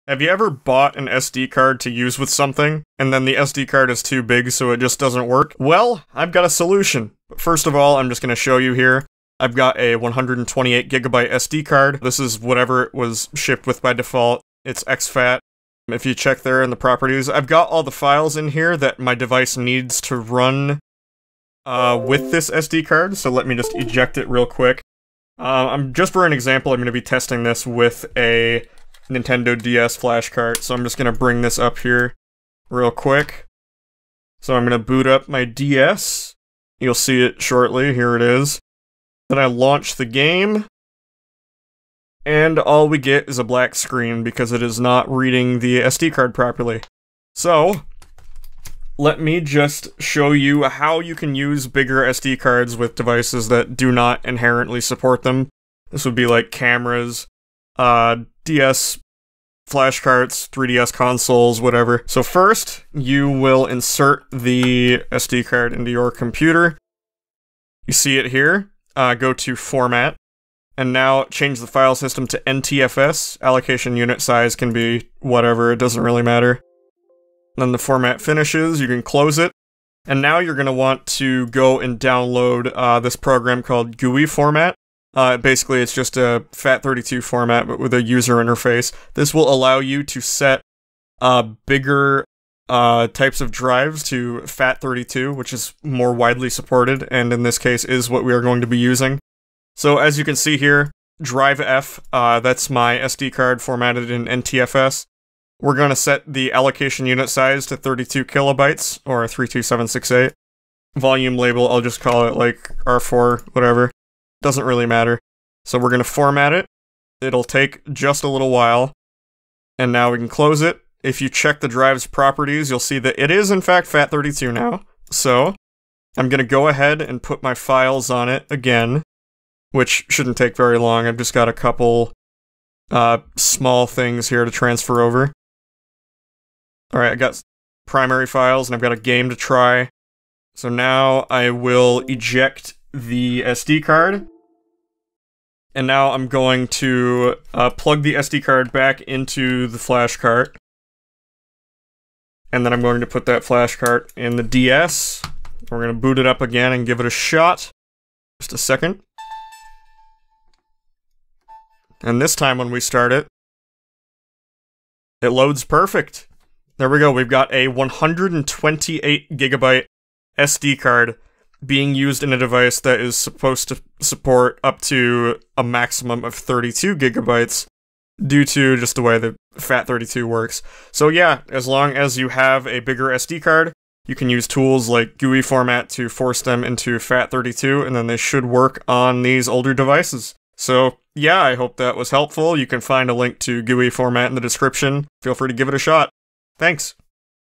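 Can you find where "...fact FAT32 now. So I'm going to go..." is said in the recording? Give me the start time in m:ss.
2:03.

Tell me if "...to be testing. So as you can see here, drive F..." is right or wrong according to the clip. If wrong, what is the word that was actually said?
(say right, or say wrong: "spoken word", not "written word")
wrong: "using", not "testing".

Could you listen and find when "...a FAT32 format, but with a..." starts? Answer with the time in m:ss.
1:26.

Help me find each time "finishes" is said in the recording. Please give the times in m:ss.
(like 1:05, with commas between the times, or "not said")
1:18.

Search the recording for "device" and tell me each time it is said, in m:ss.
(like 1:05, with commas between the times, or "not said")
0:19, 0:52, 2:52, 3:09.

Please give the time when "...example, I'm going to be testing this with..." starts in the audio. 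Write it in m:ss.
0:26.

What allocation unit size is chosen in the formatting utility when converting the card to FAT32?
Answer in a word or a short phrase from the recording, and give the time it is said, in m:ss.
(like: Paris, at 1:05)
32 kilobytes, at 1:47.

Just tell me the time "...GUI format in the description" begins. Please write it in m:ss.
3:13.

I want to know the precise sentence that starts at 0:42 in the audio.
And all we get is a black screen because it is not reading the SD card properly.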